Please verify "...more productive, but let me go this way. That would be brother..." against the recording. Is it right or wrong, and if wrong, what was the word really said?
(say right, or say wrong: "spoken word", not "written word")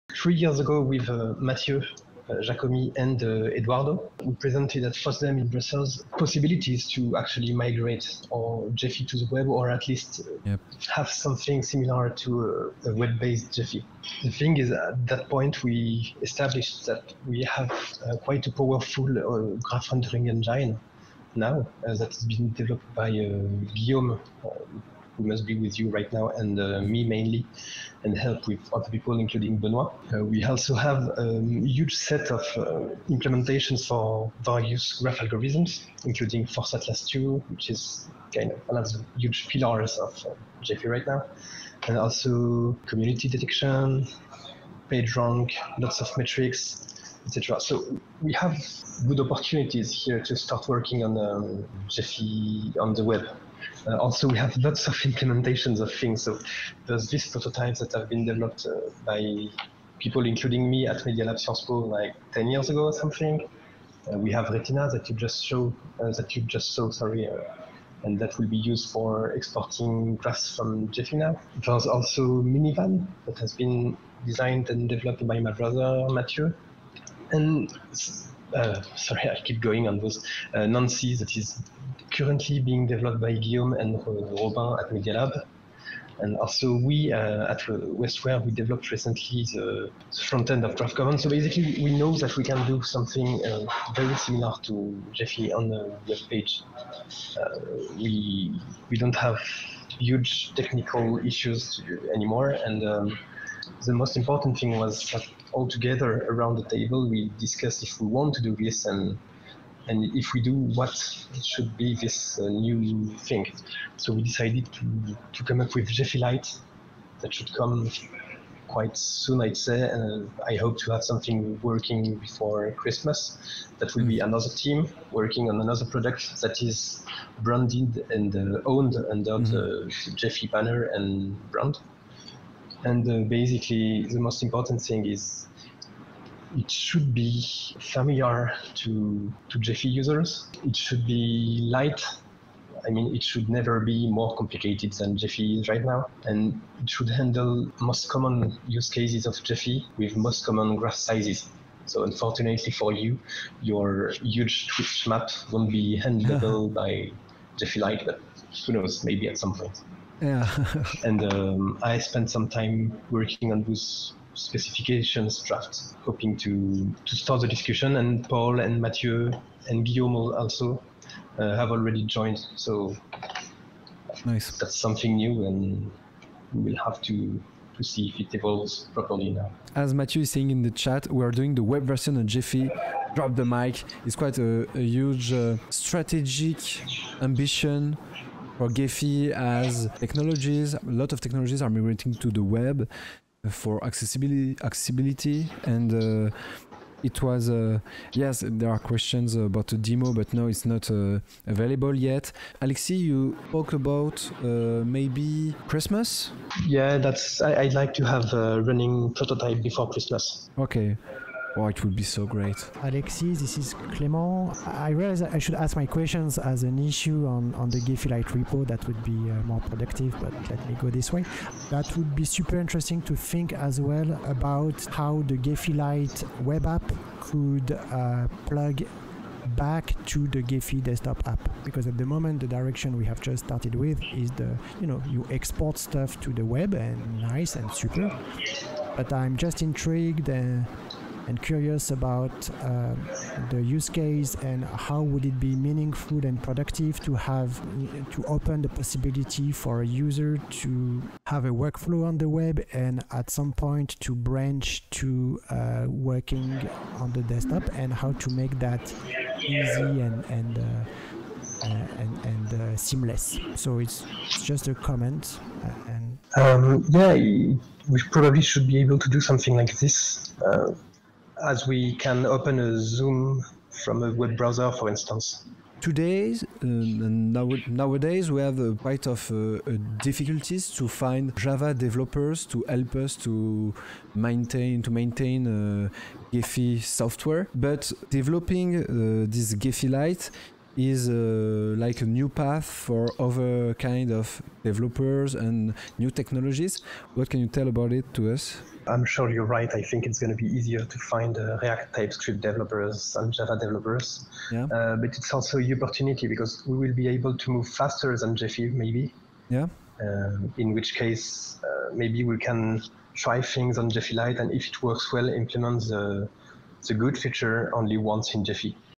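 wrong: "super", not "brother".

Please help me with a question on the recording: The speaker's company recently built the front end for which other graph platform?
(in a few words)
Graph Commons.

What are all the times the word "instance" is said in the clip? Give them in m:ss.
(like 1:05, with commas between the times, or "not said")
4:34.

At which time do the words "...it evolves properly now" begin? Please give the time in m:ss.
2:58.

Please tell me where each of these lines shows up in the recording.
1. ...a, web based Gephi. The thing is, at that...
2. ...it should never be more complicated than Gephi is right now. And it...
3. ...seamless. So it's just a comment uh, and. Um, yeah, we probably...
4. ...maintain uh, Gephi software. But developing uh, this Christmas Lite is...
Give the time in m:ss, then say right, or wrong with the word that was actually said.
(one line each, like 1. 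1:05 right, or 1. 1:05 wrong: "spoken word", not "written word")
1. 0:12 right
2. 2:23 right
3. 4:22 right
4. 4:44 wrong: "Gephi", not "Christmas".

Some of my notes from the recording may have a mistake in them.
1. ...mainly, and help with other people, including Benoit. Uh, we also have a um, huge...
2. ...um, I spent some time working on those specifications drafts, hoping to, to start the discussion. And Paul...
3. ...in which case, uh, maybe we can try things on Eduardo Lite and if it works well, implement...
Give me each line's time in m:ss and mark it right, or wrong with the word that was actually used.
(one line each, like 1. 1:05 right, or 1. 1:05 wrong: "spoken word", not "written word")
1. 0:27 right
2. 2:41 right
3. 5:10 wrong: "Gephi", not "Eduardo".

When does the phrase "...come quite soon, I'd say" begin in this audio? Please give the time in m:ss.
1:57.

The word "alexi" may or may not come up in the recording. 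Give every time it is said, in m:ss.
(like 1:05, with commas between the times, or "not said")
3:22, 3:32.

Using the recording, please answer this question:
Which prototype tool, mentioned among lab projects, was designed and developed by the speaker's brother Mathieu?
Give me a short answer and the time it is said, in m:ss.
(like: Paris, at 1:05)
Minivan, at 1:12.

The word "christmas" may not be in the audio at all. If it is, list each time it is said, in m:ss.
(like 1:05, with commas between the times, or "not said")
2:02, 3:25, 3:29.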